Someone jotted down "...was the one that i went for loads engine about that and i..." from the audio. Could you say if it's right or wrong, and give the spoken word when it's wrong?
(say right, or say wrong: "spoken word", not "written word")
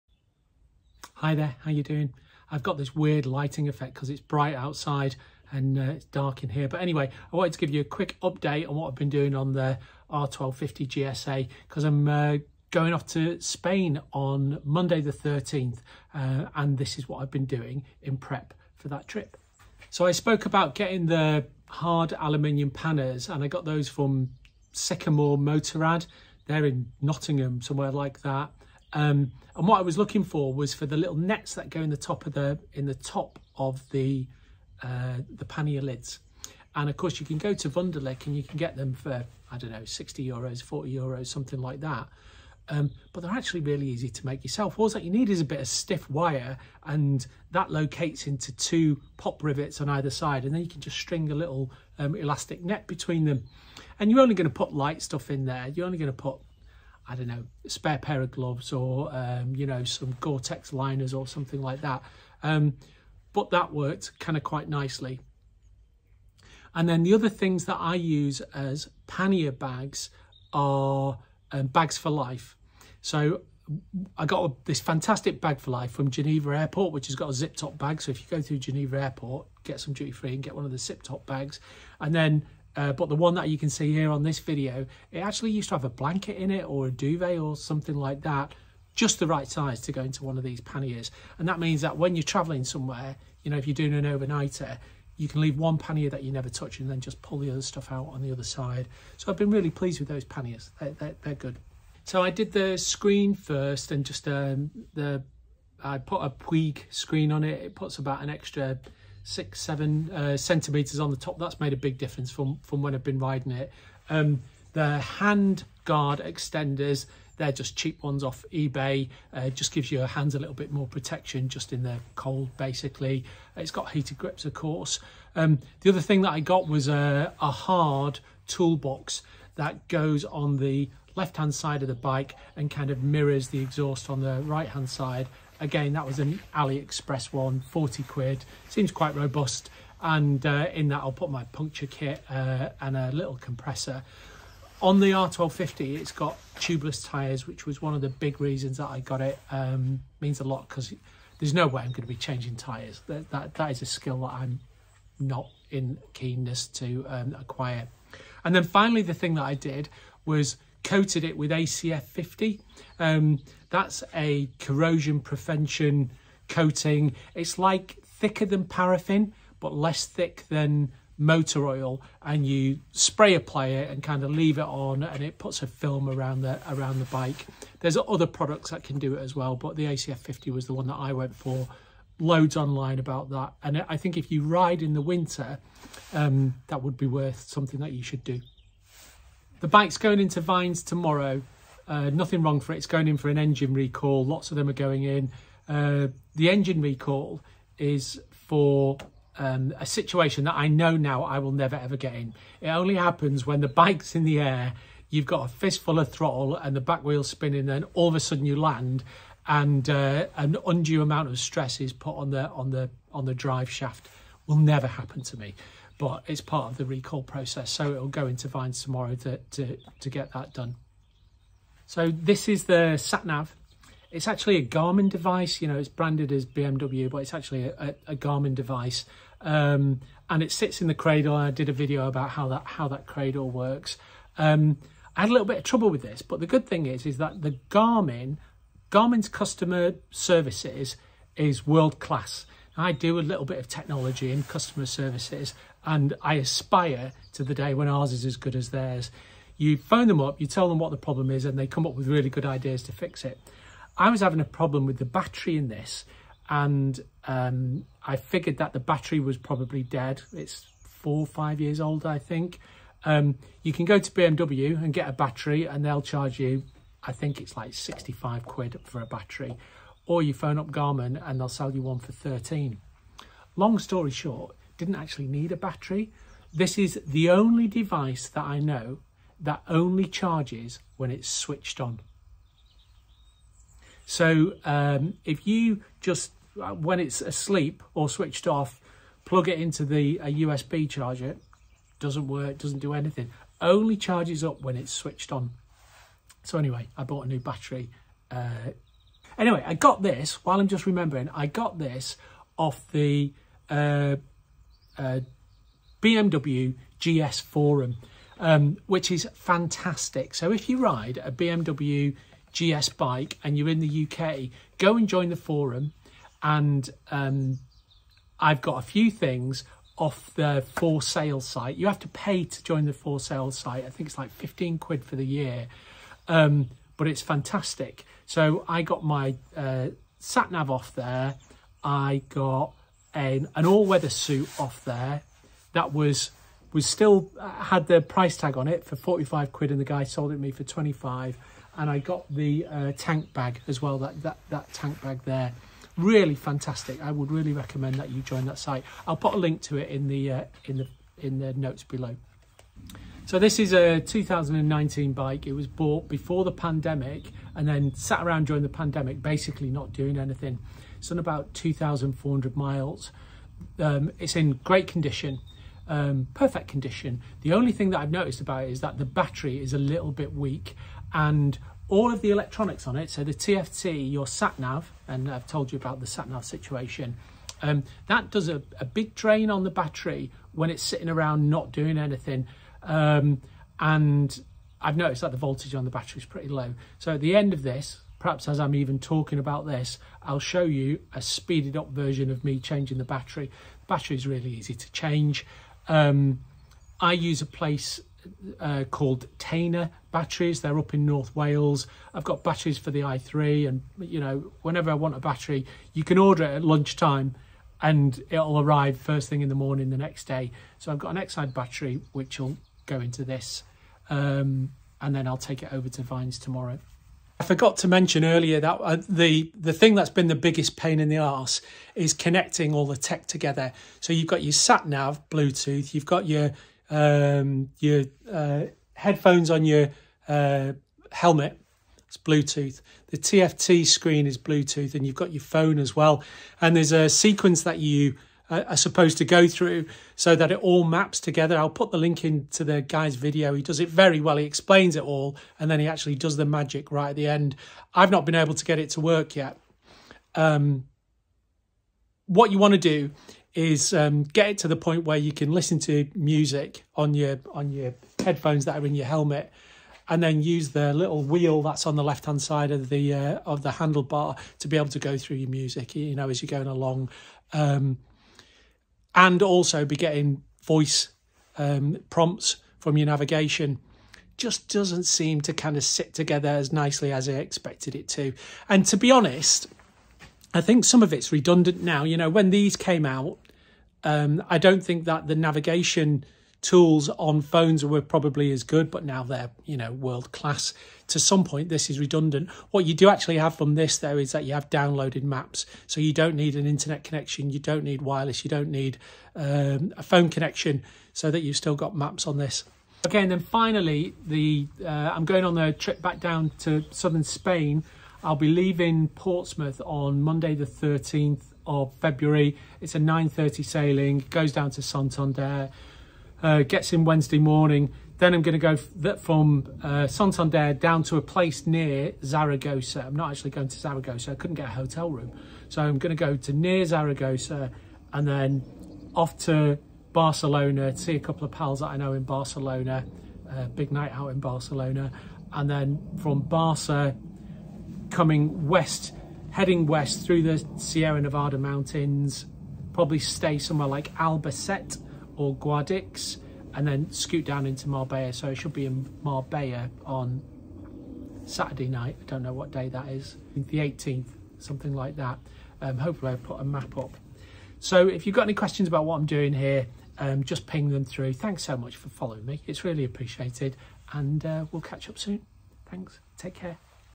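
wrong: "online", not "engine".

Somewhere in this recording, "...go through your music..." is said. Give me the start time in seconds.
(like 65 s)
464 s.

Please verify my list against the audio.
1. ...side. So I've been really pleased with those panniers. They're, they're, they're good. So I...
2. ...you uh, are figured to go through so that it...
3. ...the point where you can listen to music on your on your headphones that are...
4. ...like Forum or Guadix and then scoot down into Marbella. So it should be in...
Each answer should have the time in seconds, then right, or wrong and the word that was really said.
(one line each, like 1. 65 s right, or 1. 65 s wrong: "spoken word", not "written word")
1. 98 s right
2. 437 s wrong: "supposed", not "figured"
3. 454 s right
4. 543 s wrong: "Albacete", not "Forum".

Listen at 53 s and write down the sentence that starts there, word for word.
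And you're only going to put light stuff in there.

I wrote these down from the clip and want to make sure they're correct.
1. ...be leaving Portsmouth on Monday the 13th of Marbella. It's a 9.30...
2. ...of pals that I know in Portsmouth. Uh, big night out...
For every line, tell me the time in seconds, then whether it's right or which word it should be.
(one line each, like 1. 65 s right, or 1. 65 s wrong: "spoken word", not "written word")
1. 508 s wrong: "February", not "Marbella"
2. 531 s wrong: "Barcelona", not "Portsmouth".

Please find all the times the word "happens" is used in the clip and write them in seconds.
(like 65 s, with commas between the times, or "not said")
202 s, 214 s.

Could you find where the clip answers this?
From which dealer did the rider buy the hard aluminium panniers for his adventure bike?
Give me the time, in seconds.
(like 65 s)
24 s.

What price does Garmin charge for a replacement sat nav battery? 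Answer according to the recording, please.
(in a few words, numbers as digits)
13.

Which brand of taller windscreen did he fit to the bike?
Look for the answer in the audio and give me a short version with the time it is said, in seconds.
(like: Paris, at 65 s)
Puig, at 106 s.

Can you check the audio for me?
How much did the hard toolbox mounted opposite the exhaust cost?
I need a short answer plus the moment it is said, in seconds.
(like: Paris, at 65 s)
40 quid, at 137 s.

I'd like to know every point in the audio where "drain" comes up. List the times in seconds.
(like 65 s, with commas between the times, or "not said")
379 s.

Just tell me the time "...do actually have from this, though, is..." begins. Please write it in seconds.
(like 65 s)
492 s.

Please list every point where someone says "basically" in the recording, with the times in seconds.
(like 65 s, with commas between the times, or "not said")
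122 s, 359 s.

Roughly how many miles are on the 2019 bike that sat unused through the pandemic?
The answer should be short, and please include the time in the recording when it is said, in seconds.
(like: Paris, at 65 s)
2,400 miles, at 361 s.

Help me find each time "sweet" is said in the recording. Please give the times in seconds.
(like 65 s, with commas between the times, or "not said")
not said.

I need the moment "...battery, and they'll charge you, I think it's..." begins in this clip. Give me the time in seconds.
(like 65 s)
265 s.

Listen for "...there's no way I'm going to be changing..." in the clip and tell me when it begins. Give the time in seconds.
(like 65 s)
151 s.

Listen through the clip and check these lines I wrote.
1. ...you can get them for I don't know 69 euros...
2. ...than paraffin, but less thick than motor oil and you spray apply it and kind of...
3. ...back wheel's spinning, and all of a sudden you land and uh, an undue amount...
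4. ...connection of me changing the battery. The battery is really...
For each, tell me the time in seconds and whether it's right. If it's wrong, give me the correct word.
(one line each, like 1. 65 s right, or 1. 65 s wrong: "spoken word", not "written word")
1. 38 s wrong: "60", not "69"
2. 168 s right
3. 206 s right
4. 391 s wrong: "version", not "connection".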